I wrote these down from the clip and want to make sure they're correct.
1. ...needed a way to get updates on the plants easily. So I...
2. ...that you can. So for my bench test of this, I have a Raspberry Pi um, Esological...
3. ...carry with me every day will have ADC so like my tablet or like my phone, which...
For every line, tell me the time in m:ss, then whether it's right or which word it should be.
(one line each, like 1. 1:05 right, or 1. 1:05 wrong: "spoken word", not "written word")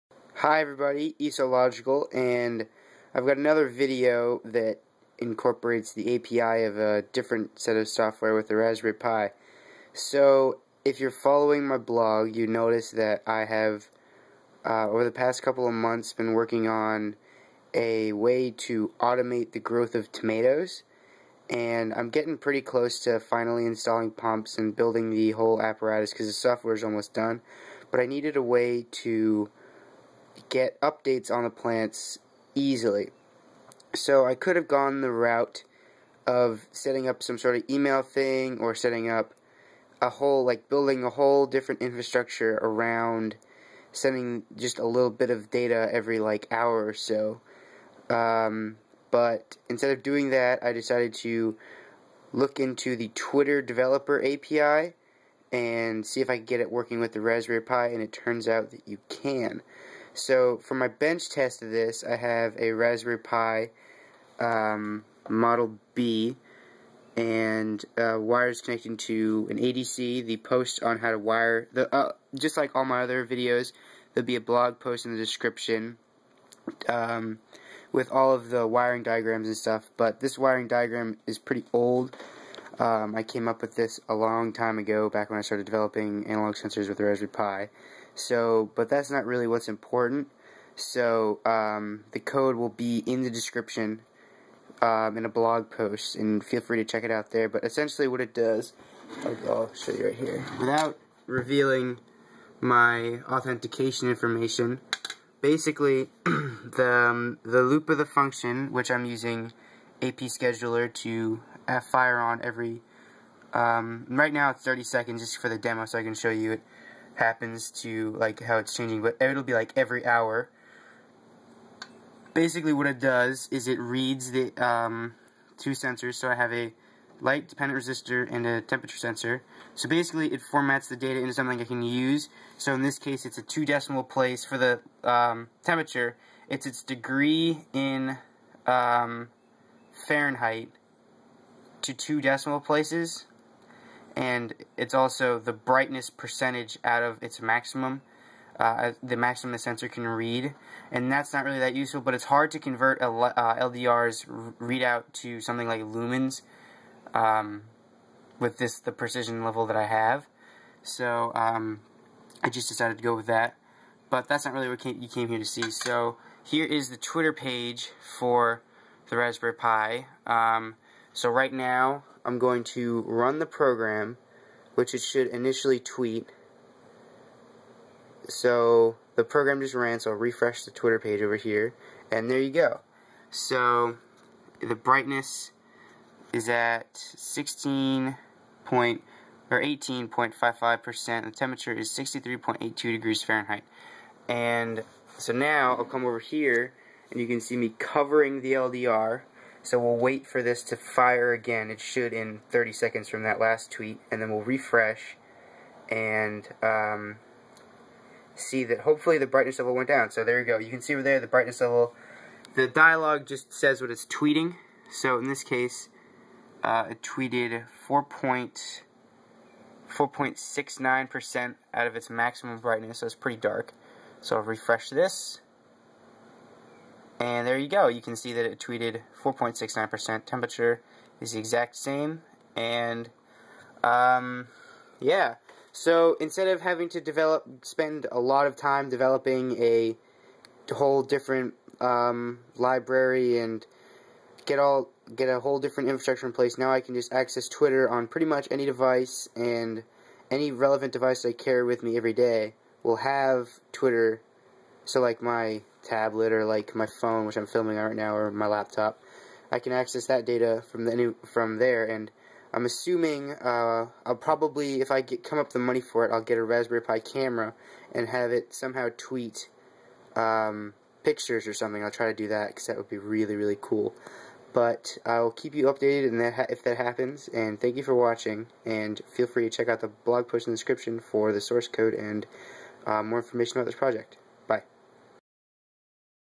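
1. 0:28 right
2. 0:58 wrong: "Model", not "Esological"
3. 4:11 wrong: "Twitter", not "ADC".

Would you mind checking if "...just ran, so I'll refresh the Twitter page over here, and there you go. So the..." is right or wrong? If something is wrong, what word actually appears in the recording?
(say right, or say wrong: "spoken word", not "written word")
right.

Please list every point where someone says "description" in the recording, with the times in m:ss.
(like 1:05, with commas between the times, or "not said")
1:15, 1:33, 4:40.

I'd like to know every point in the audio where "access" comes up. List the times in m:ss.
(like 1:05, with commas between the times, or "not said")
4:07, 4:19.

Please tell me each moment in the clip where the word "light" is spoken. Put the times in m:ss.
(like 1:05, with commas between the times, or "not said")
2:07.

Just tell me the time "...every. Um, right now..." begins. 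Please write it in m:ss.
1:52.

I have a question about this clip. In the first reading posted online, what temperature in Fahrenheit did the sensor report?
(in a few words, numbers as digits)
63.82.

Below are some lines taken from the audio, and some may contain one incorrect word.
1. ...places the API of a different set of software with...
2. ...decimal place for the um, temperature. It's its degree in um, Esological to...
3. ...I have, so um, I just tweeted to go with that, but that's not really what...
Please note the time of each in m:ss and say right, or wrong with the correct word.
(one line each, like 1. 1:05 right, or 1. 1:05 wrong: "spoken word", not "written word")
1. 0:05 wrong: "incorporates", not "places"
2. 2:13 wrong: "Fahrenheit", not "Esological"
3. 2:39 wrong: "decided", not "tweeted".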